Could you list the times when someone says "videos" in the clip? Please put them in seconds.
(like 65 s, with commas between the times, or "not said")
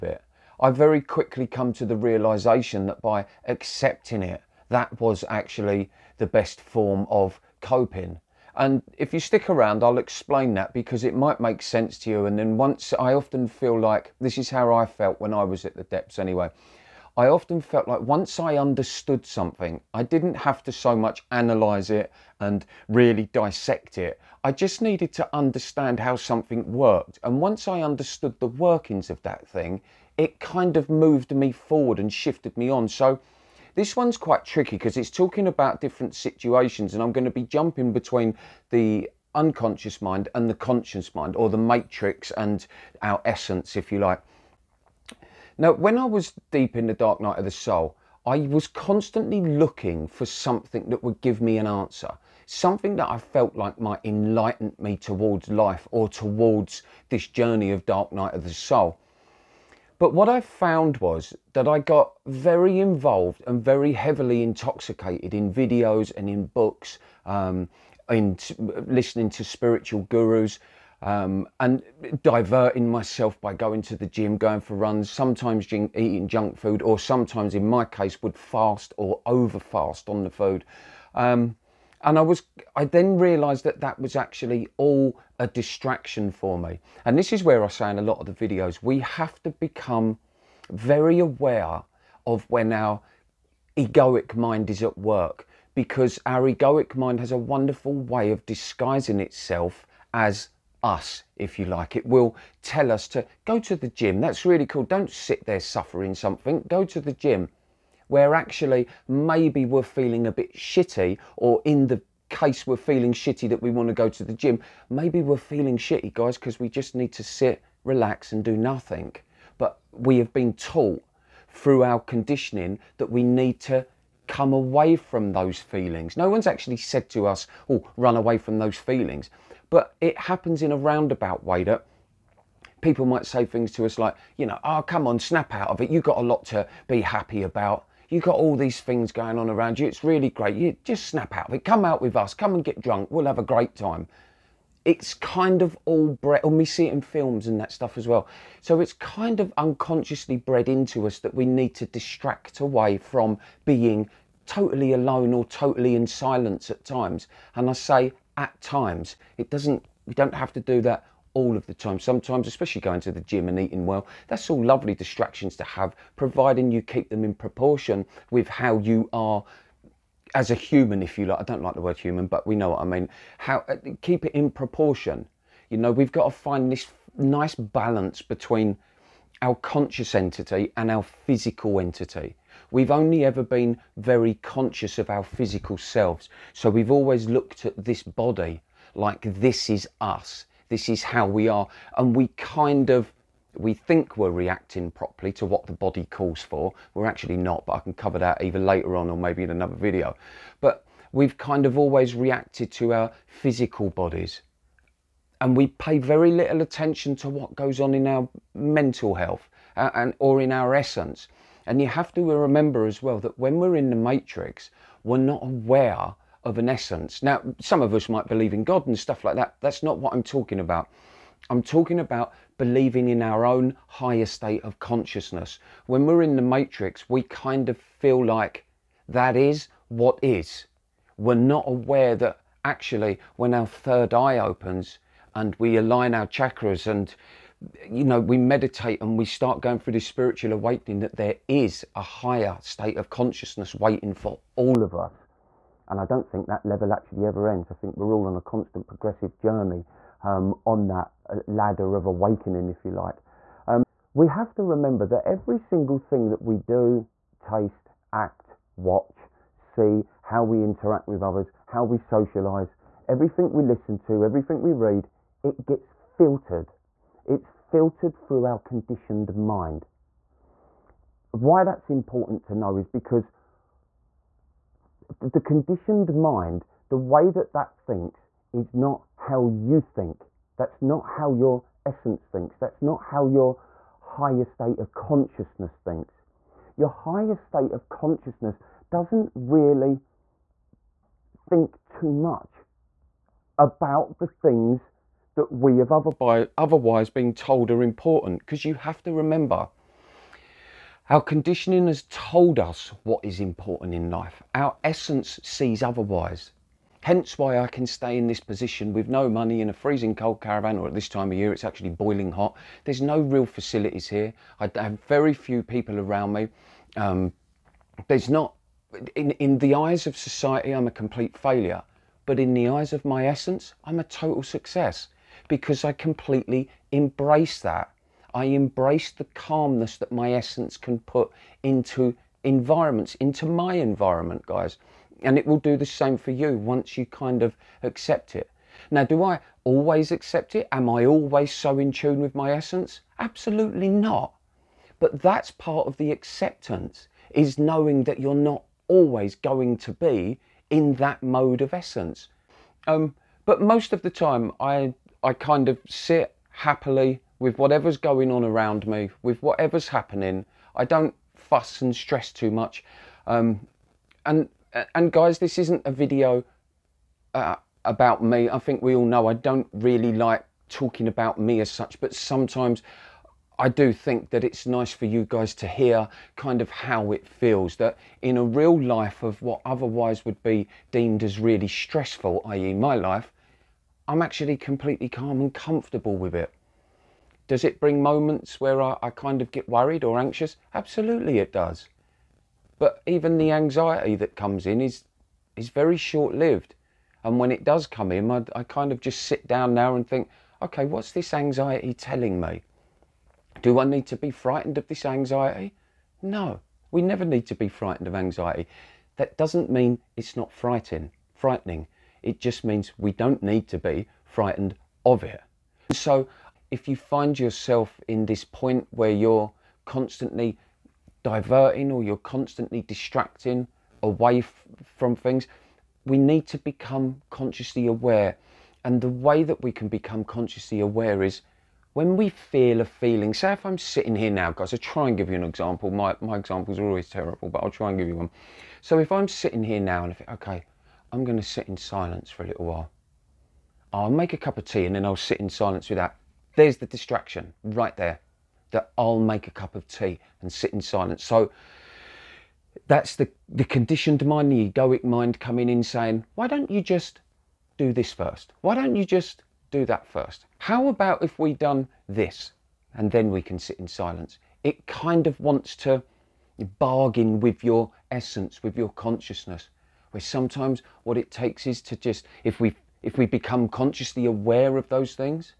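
65 s, 88 s, 199 s, 365 s.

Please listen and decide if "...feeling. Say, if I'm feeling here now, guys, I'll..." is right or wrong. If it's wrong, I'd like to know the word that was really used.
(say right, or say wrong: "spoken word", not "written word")
wrong: "sitting", not "feeling".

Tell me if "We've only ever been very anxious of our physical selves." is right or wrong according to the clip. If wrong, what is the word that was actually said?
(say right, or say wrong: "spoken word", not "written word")
wrong: "conscious", not "anxious".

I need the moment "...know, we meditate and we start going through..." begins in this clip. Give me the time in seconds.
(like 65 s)
238 s.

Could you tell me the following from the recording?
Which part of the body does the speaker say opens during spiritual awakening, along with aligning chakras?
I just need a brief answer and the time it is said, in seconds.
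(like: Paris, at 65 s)
third eye, at 233 s.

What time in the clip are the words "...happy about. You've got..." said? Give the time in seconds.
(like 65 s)
137 s.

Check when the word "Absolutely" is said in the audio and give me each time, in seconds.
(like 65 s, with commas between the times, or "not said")
343 s, 390 s.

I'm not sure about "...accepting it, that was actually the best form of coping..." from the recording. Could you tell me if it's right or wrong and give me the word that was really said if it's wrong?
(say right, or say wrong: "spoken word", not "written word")
right.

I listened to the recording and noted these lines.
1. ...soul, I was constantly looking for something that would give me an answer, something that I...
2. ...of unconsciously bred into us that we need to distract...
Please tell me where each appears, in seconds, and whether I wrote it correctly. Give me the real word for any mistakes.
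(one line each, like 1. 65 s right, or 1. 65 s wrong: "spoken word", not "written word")
1. 47 s right
2. 149 s right.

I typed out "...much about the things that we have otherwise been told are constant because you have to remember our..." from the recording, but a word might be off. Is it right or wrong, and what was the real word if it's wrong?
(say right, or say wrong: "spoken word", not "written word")
wrong: "important", not "constant".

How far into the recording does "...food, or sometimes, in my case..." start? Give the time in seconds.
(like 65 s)
76 s.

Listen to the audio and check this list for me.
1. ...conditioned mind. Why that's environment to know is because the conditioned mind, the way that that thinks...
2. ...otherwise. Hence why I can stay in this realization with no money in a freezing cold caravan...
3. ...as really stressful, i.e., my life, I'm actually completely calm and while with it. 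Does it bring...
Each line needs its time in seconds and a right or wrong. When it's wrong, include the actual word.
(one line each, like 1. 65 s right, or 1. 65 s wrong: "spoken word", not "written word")
1. 268 s wrong: "important", not "environment"
2. 305 s wrong: "position", not "realization"
3. 381 s wrong: "comfortable", not "while".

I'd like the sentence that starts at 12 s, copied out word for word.
And then once I often feel like this is how I felt when I was at the depths anyway.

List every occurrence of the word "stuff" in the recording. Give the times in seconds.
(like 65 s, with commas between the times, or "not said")
147 s, 218 s.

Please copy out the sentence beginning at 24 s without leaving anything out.
I just needed to understand how something worked.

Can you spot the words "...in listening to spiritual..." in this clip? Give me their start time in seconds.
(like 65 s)
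68 s.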